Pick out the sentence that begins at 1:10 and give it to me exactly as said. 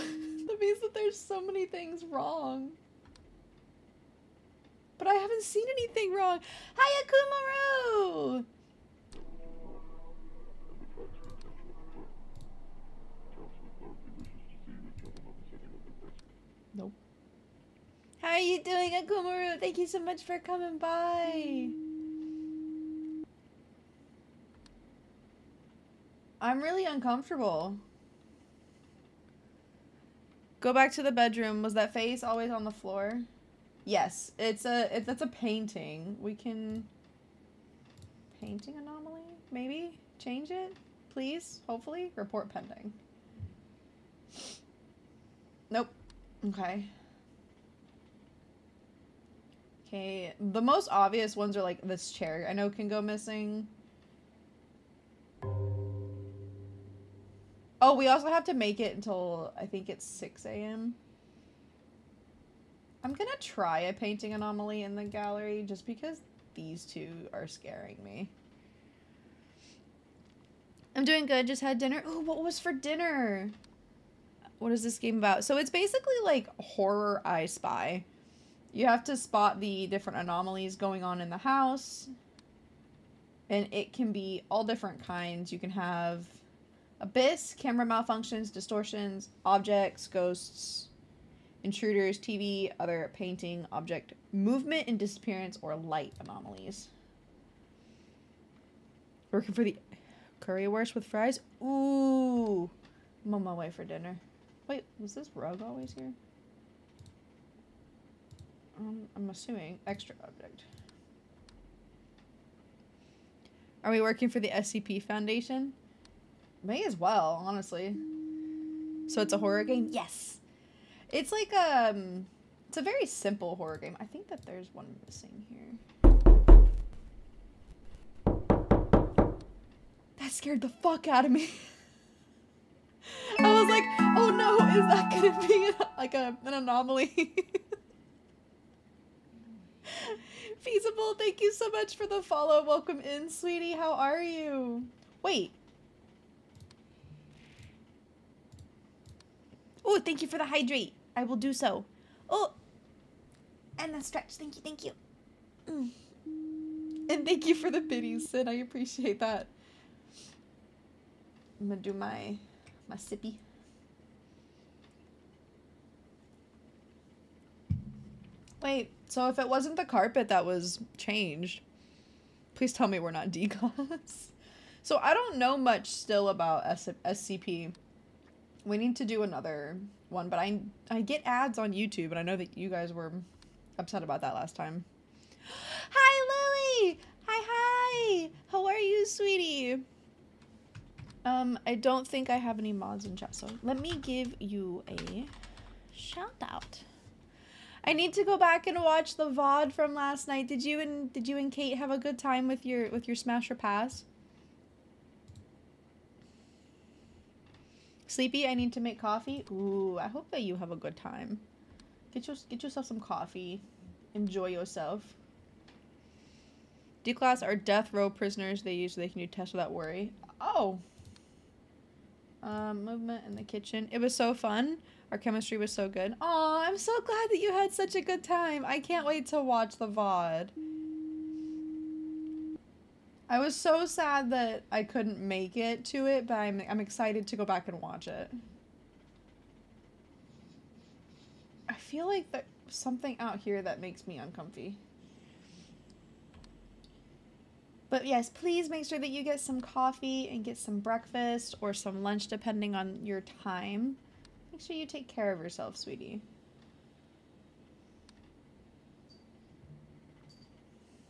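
I'm doing good, just had dinner.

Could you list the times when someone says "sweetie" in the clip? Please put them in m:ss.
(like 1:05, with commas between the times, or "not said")
2:23, 3:09, 4:15.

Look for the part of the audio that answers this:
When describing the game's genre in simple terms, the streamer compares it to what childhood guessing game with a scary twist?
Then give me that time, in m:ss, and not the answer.
1:16.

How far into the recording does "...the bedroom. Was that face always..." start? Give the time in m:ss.
0:31.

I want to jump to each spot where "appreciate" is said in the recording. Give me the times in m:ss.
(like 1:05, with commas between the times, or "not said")
2:38.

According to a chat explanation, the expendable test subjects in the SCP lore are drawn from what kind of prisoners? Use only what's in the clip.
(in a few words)
death row prisoners.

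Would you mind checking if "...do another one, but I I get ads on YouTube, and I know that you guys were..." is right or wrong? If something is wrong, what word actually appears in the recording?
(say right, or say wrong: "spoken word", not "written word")
right.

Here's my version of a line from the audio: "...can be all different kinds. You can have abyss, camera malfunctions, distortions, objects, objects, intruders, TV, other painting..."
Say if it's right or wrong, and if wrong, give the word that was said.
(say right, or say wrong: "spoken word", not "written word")
wrong: "ghosts", not "objects".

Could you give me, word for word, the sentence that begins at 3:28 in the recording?
Sleepy, I need to make coffee.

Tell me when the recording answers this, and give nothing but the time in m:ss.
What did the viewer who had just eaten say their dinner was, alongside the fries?
1:40.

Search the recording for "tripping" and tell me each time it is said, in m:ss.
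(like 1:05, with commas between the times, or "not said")
not said.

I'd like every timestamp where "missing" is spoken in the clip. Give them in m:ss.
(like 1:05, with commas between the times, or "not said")
0:53, 2:05.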